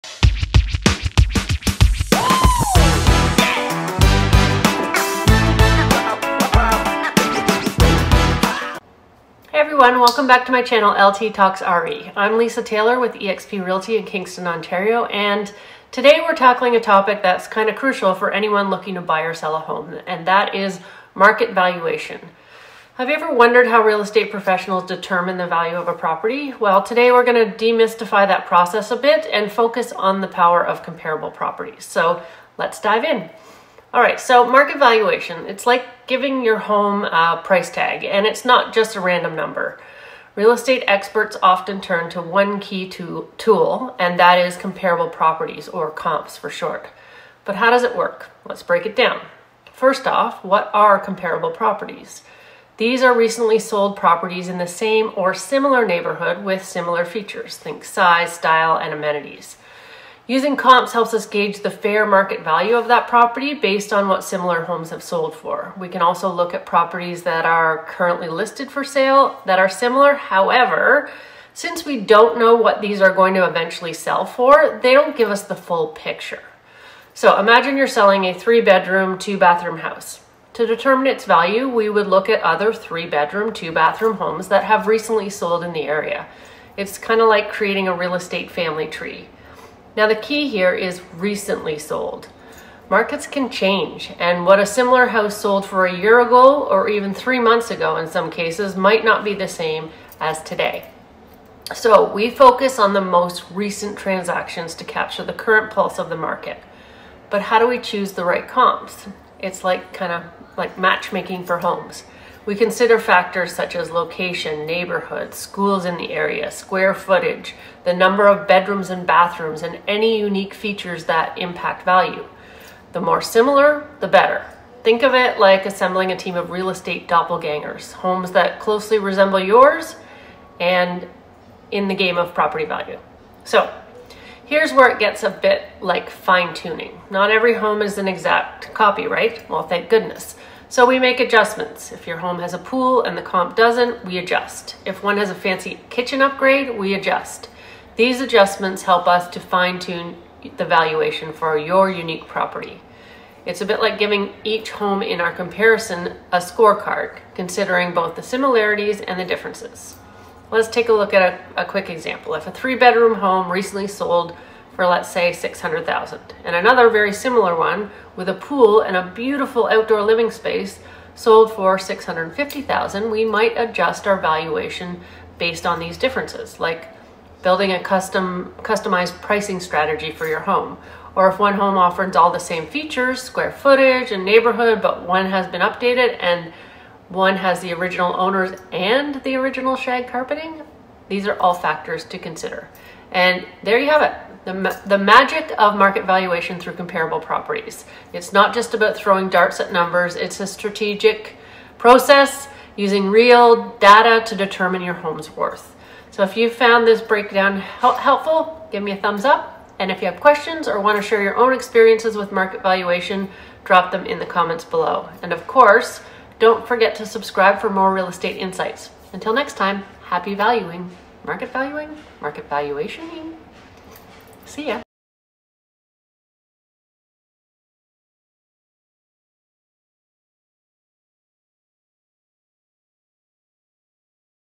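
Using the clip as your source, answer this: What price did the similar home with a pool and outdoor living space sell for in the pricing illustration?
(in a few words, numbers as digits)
650,000.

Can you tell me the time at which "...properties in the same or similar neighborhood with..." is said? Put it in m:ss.
0:53.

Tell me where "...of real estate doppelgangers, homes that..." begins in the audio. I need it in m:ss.
2:06.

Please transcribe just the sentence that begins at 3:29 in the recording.
And if you have questions or want to share your own experiences with market valuation, drop them in the comments below.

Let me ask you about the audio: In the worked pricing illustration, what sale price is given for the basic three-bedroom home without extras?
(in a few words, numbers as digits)
600,000.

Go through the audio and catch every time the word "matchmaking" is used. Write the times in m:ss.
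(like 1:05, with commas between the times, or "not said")
1:50.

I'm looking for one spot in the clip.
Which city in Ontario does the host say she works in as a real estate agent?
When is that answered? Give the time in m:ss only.
0:14.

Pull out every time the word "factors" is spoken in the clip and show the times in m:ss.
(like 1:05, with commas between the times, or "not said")
1:52, 3:11.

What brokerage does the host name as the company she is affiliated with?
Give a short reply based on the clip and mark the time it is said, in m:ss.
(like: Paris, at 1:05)
eXp Realty, at 0:13.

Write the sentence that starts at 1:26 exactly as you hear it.
It's kind of like creating a real estate family tree.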